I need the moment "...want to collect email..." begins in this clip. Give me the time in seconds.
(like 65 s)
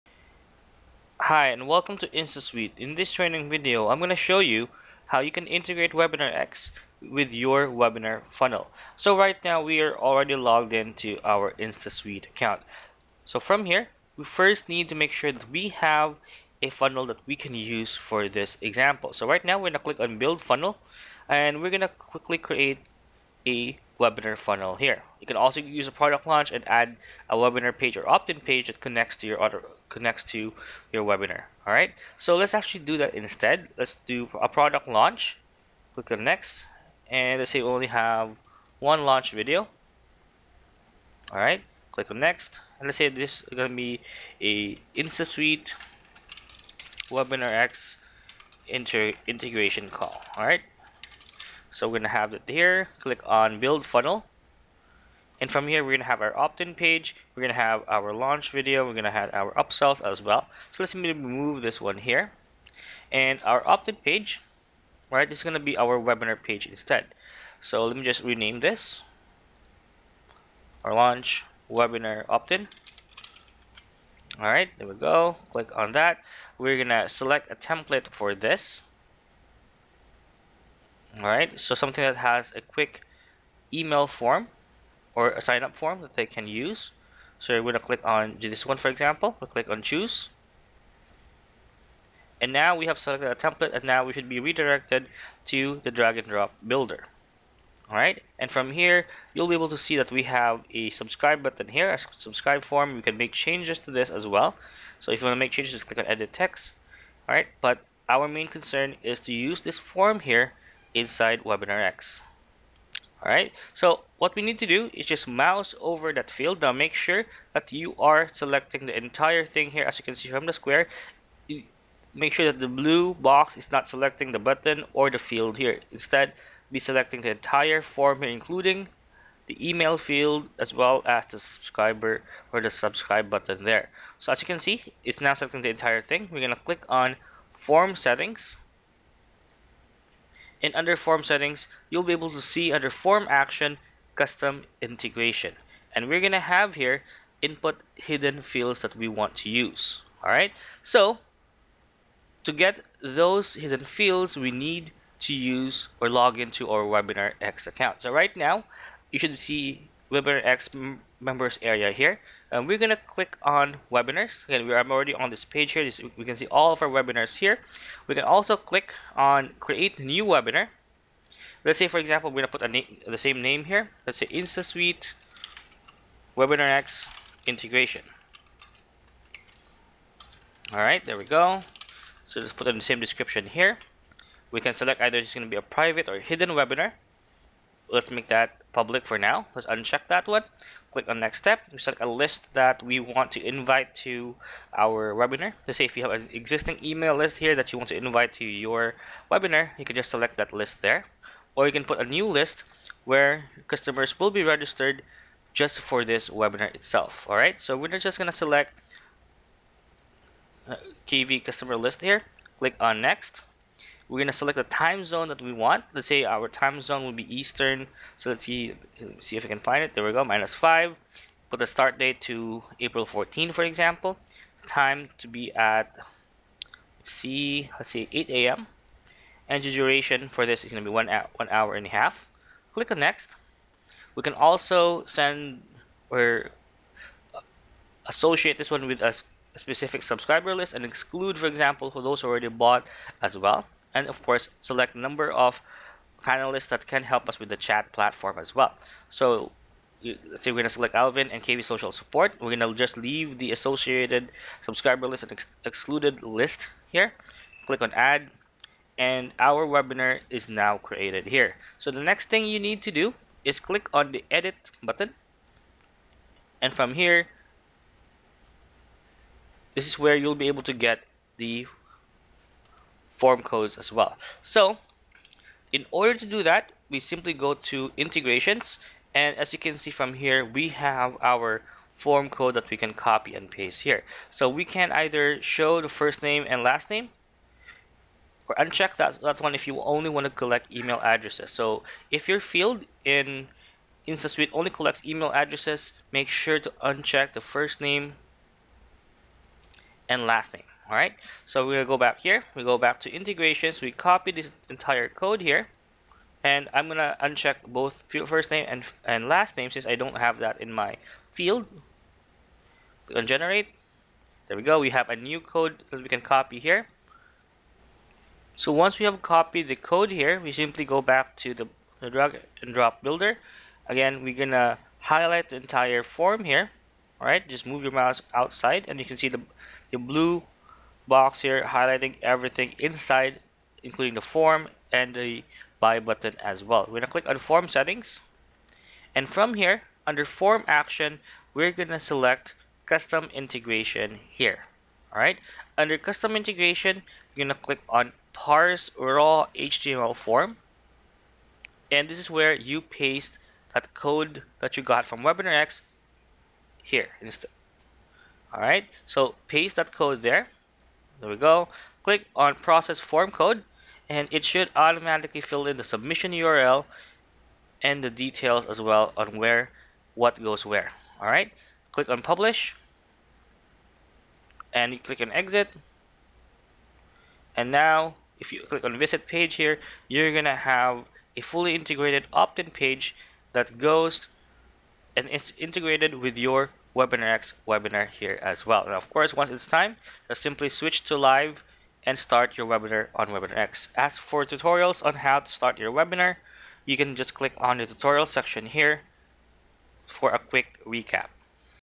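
290 s.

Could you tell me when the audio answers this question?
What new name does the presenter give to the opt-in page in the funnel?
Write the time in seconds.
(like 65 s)
70 s.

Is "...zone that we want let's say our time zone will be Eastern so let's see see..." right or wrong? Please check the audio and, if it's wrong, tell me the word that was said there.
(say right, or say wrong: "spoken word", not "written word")
right.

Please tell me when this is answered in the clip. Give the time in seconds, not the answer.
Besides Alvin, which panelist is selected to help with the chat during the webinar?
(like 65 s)
251 s.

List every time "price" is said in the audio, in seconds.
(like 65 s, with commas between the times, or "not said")
not said.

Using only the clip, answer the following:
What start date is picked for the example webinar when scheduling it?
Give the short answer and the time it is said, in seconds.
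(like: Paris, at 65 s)
April 14, at 222 s.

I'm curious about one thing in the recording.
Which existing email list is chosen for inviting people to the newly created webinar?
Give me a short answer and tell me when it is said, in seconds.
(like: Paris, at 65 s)
KV customer list, at 211 s.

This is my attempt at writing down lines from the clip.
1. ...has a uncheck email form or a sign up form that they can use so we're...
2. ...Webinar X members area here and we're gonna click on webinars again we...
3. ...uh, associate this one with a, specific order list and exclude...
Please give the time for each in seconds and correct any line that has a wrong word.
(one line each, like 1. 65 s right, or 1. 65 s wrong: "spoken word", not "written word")
1. 82 s wrong: "quick", not "uncheck"
2. 160 s right
3. 237 s wrong: "subscriber", not "order".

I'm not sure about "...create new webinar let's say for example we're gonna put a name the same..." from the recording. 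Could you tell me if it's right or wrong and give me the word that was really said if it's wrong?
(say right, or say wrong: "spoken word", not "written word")
right.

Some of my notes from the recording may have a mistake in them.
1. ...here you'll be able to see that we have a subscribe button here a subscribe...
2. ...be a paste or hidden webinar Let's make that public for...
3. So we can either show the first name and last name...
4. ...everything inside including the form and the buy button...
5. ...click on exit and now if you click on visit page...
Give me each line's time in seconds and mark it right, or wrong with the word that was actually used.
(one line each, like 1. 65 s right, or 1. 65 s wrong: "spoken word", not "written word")
1. 98 s right
2. 185 s wrong: "private", not "paste"
3. 284 s right
4. 332 s right
5. 374 s right.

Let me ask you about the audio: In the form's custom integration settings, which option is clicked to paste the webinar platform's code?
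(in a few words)
Parse raw HTML form.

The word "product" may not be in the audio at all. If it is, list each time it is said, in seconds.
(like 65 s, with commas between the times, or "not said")
25 s, 34 s.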